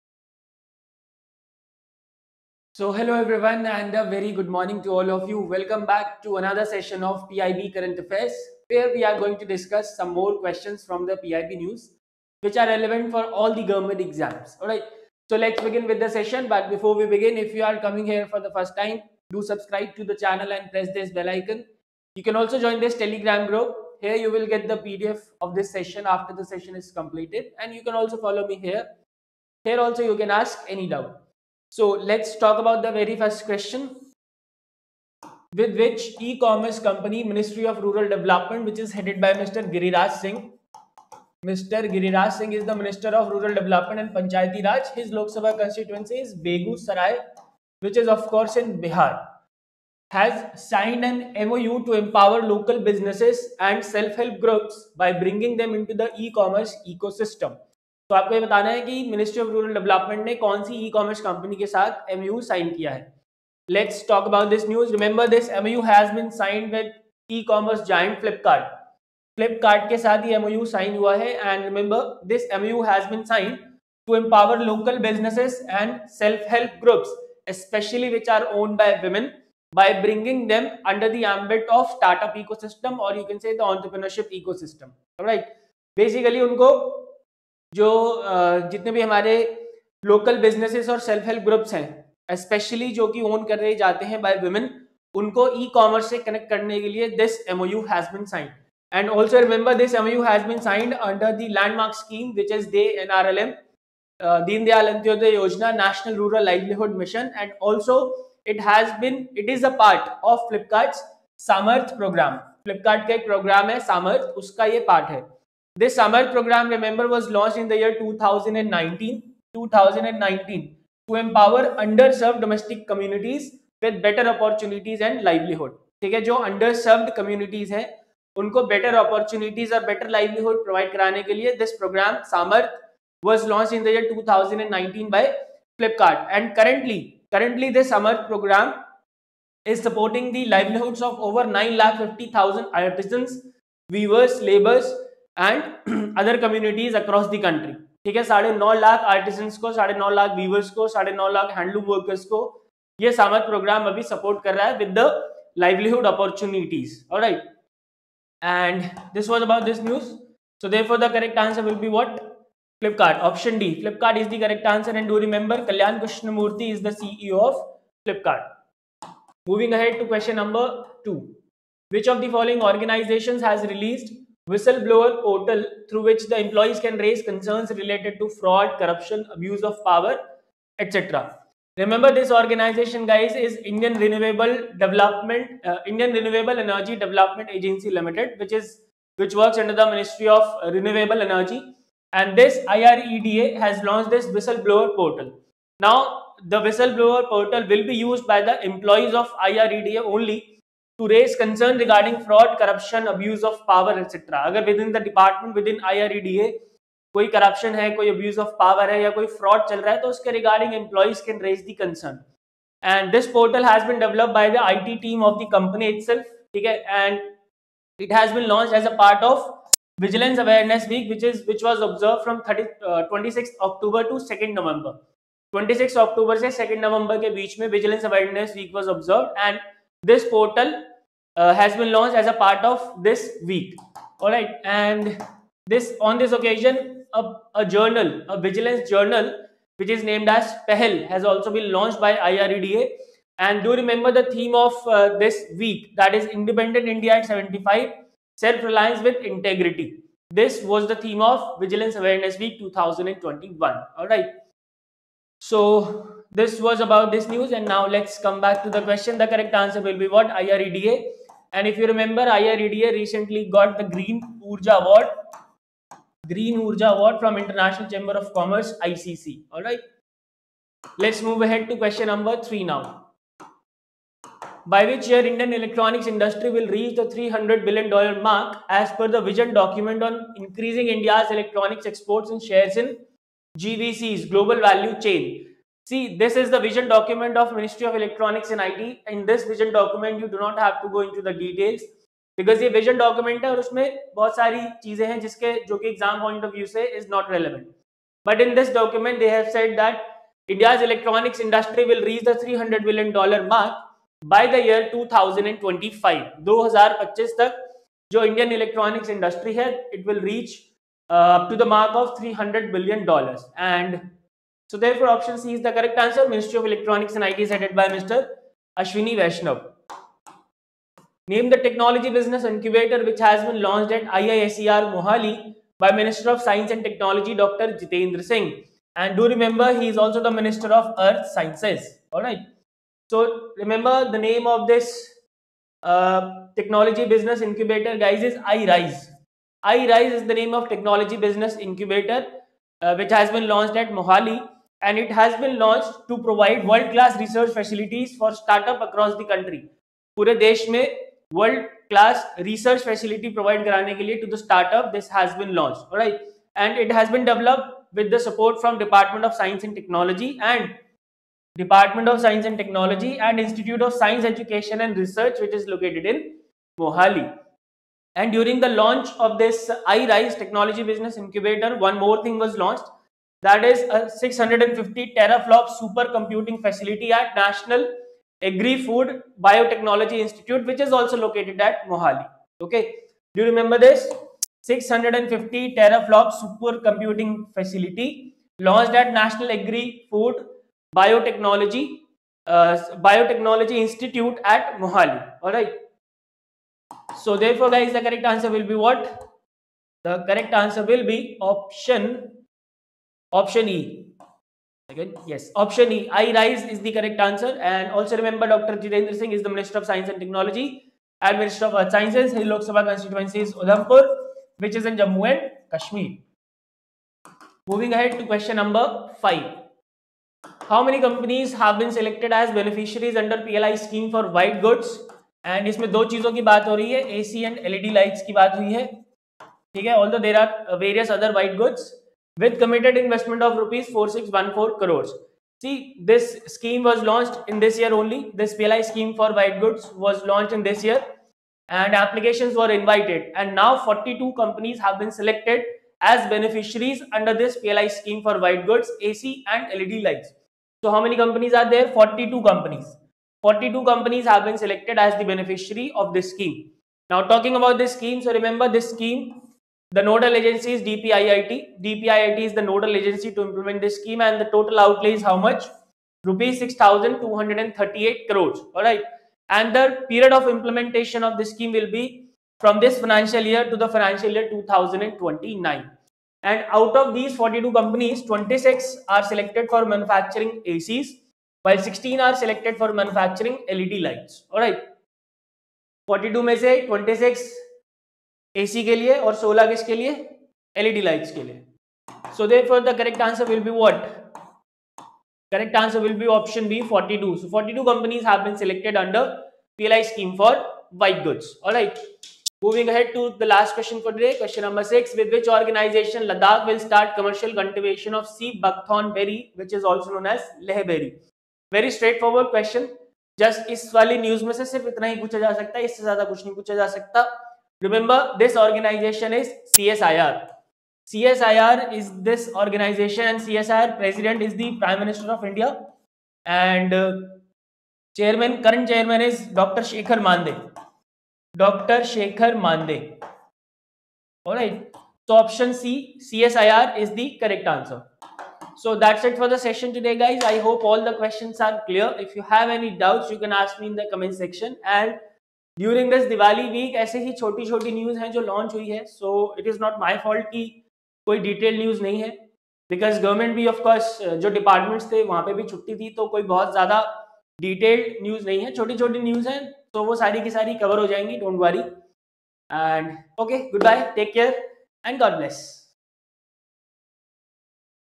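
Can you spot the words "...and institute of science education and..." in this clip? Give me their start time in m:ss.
6:03.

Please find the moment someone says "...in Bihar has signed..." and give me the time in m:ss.
0:48.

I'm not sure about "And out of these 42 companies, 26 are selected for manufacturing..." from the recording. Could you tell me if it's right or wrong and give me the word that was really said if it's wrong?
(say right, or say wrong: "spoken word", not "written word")
right.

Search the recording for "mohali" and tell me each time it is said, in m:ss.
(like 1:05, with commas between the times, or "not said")
5:24, 5:43, 6:06, 6:21, 6:34.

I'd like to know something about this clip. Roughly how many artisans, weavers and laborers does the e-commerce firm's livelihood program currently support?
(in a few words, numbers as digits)
9 lakh 50 thousand.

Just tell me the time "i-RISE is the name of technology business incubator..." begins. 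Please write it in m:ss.
5:39.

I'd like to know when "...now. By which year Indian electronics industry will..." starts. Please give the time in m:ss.
4:32.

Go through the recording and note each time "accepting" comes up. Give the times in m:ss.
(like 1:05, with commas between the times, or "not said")
not said.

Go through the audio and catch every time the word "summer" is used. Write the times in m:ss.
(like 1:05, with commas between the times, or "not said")
1:55, 2:17.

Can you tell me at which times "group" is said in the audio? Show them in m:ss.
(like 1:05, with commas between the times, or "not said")
0:23, 0:54.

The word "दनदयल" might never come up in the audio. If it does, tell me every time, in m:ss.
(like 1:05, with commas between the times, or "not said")
1:44.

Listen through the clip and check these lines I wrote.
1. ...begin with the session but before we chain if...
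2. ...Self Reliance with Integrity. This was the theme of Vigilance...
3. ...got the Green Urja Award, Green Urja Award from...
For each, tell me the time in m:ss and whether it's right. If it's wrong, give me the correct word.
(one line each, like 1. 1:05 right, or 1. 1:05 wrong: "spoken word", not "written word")
1. 0:15 wrong: "begin", not "chain"
2. 4:08 right
3. 4:23 right.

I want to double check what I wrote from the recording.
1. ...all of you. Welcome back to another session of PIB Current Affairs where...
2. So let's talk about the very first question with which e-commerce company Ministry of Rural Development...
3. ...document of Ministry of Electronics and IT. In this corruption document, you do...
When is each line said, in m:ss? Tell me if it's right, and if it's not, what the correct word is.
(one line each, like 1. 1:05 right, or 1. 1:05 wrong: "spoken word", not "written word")
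1. 0:04 right
2. 0:31 right
3. 4:46 wrong: "vision", not "corruption".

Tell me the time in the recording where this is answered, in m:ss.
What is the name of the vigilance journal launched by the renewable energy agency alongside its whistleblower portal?
4:00.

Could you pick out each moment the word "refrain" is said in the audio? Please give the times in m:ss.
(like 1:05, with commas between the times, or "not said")
not said.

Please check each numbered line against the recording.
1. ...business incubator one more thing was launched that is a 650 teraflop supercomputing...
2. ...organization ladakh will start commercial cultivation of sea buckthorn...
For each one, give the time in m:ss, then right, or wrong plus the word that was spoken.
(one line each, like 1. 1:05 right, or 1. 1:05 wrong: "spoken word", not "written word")
1. 6:10 right
2. 8:25 right.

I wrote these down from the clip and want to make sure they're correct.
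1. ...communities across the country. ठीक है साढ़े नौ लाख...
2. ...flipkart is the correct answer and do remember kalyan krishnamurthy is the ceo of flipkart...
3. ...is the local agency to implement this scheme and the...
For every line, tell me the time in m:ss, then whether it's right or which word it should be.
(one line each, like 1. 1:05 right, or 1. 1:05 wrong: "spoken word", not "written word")
1. 2:26 right
2. 2:43 right
3. 7:42 wrong: "nodal", not "local".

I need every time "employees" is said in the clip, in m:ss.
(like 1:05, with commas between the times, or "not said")
2:56, 3:18, 3:30.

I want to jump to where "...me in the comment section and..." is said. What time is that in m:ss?
9:03.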